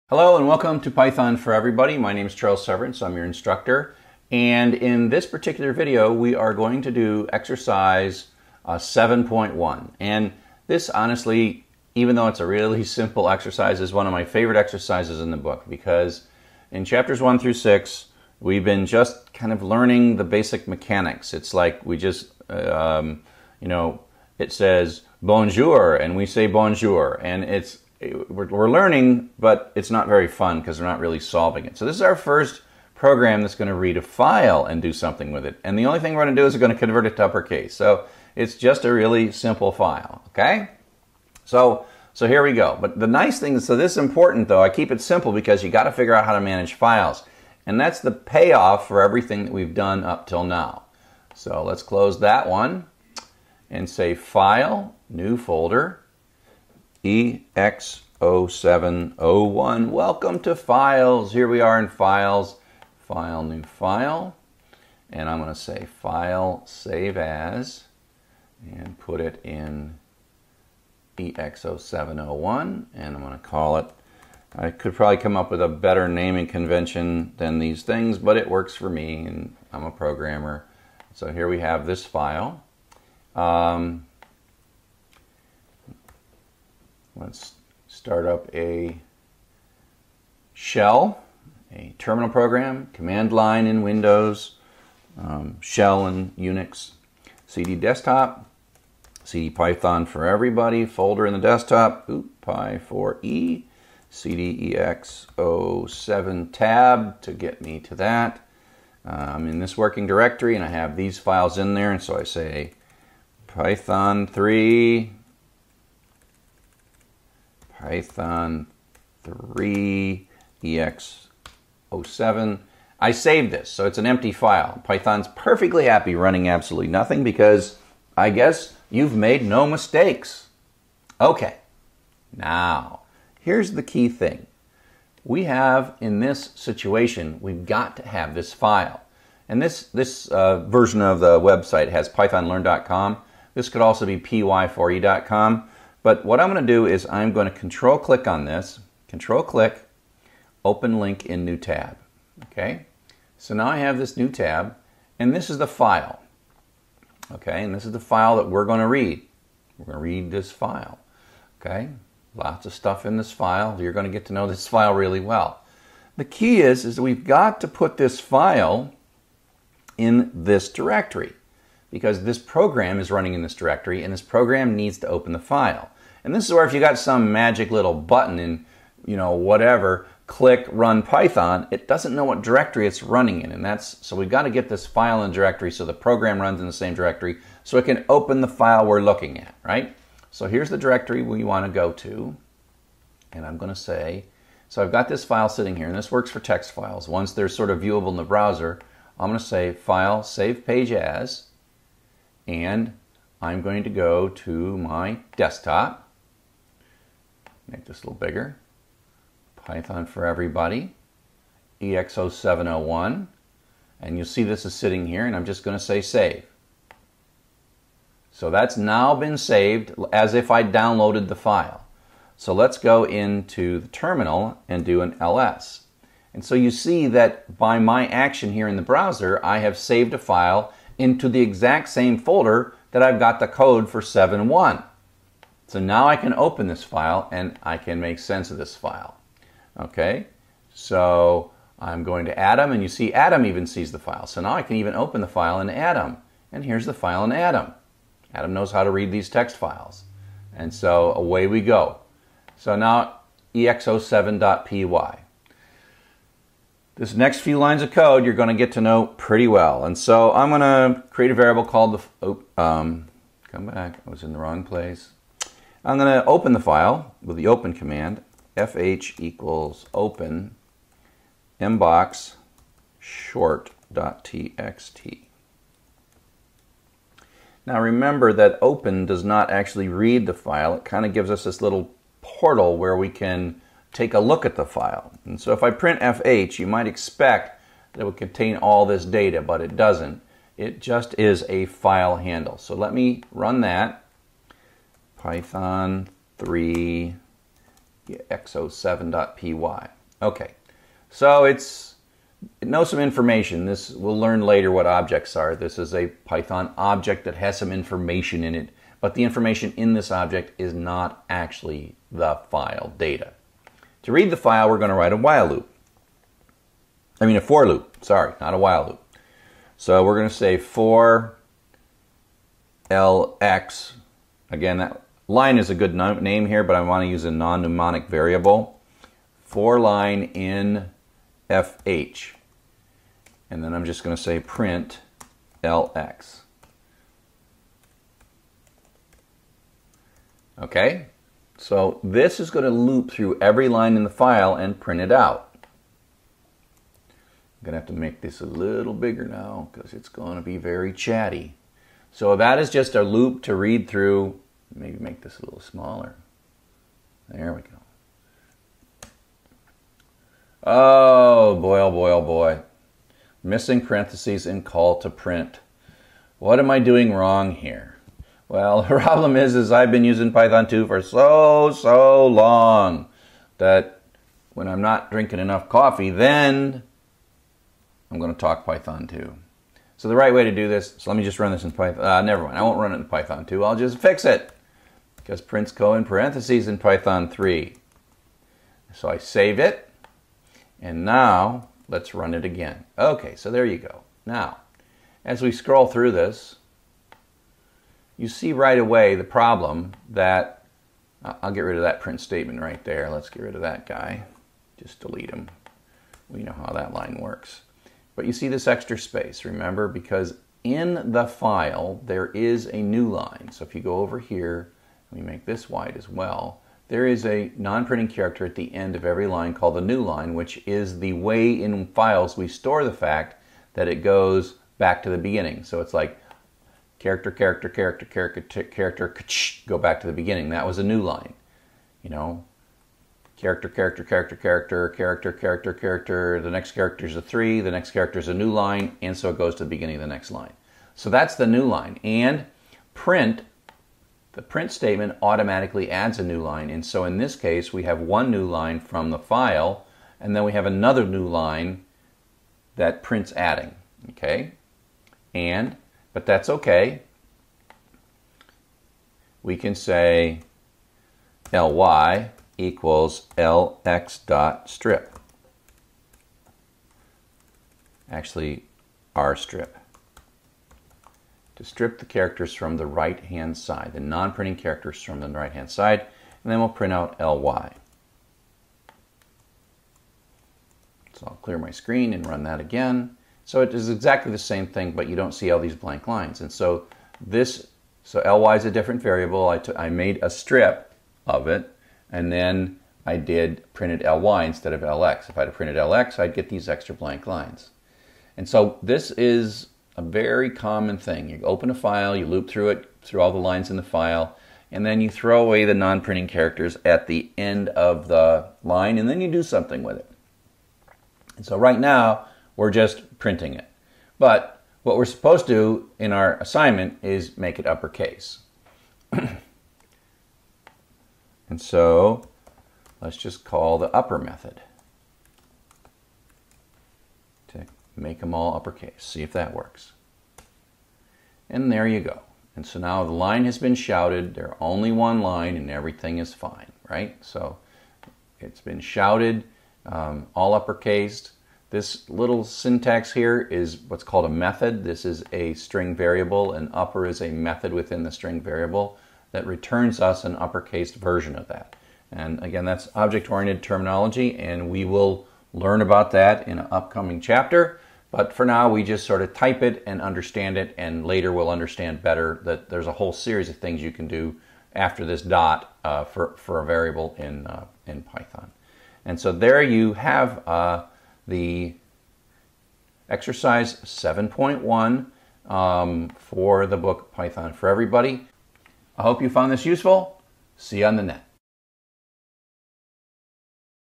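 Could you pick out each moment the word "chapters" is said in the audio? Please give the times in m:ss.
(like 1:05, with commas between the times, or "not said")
0:16, 9:17.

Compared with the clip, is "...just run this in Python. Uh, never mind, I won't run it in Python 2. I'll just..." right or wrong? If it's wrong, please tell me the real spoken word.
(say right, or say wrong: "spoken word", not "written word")
right.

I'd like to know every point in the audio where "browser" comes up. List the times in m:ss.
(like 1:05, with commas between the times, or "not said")
3:18, 3:48.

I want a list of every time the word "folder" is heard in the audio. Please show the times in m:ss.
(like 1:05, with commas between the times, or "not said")
0:55, 1:40, 3:52.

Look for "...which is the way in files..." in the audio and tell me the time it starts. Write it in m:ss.
7:00.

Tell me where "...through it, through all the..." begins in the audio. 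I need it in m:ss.
8:22.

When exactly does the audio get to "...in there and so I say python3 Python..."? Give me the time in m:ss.
1:51.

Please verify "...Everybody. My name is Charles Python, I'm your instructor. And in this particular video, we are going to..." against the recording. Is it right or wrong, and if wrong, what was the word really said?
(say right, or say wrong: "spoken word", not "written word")
wrong: "Severance", not "Python".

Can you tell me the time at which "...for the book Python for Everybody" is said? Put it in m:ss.
9:36.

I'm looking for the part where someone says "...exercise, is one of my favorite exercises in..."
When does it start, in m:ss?
0:13.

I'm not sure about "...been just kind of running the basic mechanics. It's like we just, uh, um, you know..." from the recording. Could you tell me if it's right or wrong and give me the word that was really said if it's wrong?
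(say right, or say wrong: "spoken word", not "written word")
wrong: "learning", not "running".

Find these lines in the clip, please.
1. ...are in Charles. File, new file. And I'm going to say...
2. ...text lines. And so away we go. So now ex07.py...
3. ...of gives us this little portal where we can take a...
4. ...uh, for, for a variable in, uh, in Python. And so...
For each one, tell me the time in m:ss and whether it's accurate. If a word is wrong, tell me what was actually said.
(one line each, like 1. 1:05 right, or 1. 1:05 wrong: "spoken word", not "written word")
1. 1:01 wrong: "Files", not "Charles"
2. 4:09 wrong: "files", not "lines"
3. 4:41 right
4. 9:25 right.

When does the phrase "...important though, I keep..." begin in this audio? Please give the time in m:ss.
0:43.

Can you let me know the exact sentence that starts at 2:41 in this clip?
Okay, lots of stuff in this file.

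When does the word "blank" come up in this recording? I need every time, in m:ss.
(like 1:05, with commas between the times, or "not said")
8:05, 8:16.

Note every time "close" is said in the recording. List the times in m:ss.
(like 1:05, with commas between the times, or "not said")
0:51.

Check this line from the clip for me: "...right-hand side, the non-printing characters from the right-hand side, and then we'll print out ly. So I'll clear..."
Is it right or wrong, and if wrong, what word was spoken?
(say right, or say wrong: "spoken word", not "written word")
right.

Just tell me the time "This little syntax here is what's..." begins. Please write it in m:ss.
9:01.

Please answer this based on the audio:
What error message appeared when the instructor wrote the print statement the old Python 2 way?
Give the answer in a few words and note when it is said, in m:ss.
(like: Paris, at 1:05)
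Missing parentheses in call to print, at 6:03.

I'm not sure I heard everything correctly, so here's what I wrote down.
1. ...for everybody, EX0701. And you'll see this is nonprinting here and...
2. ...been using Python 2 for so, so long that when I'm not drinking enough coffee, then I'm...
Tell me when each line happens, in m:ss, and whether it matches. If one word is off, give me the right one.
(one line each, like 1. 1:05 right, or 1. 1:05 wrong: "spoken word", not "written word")
1. 3:30 wrong: "sitting", not "nonprinting"
2. 6:09 right.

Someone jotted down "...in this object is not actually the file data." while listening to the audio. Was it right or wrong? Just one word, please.
right.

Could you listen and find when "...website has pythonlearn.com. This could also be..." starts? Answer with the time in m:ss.
2:21.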